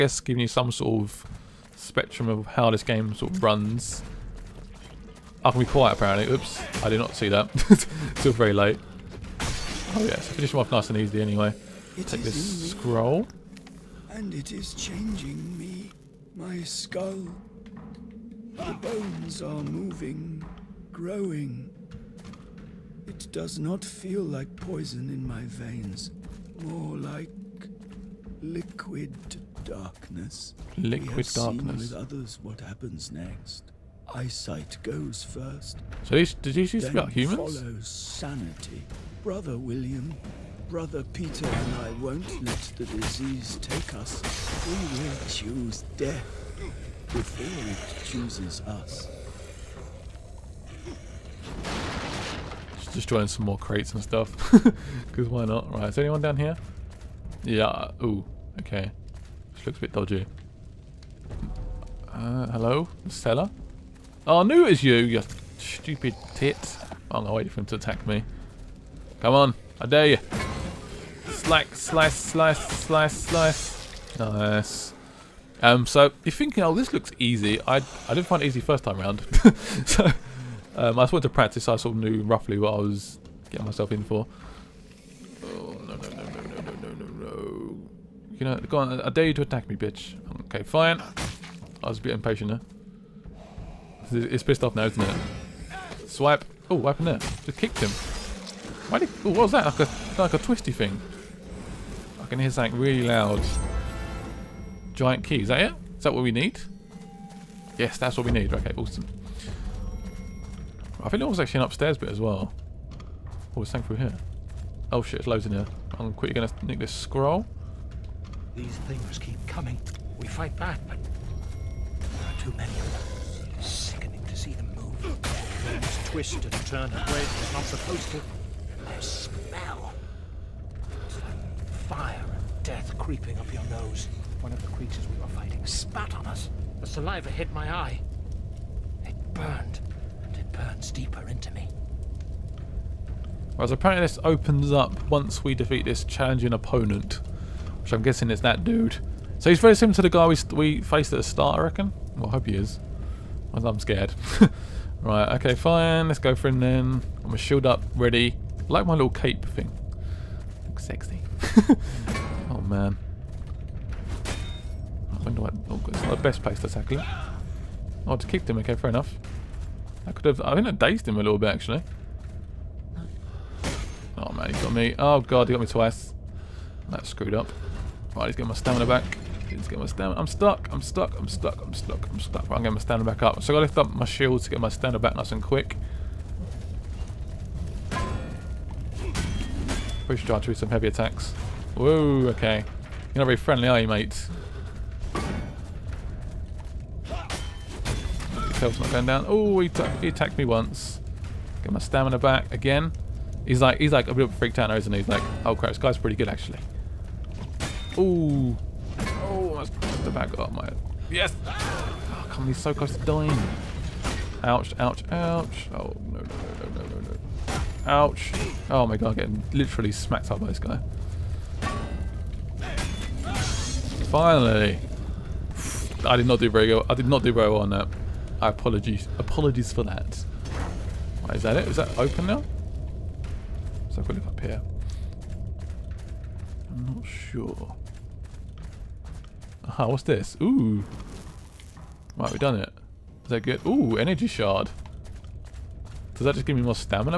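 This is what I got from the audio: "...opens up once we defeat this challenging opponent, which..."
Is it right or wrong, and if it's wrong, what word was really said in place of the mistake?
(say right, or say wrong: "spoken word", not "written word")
right.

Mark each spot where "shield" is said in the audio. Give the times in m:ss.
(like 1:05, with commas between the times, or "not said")
2:37, 3:04.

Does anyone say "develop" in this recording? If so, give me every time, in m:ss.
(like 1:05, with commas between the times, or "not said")
not said.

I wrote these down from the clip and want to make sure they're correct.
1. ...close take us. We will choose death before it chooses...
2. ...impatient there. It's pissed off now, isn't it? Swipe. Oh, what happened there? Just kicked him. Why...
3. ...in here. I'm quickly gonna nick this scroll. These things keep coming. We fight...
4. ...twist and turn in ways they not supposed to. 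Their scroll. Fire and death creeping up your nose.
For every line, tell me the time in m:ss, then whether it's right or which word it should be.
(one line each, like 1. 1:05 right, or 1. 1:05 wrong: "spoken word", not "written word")
1. 0:42 wrong: "disease", not "close"
2. 1:32 right
3. 1:55 right
4. 2:06 wrong: "smell", not "scroll".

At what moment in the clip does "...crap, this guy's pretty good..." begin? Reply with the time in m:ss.
3:25.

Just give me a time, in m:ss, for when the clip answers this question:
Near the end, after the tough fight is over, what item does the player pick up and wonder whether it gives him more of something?
4:03.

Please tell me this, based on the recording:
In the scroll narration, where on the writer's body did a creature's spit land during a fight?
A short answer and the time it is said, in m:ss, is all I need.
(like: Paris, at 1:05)
eye, at 2:17.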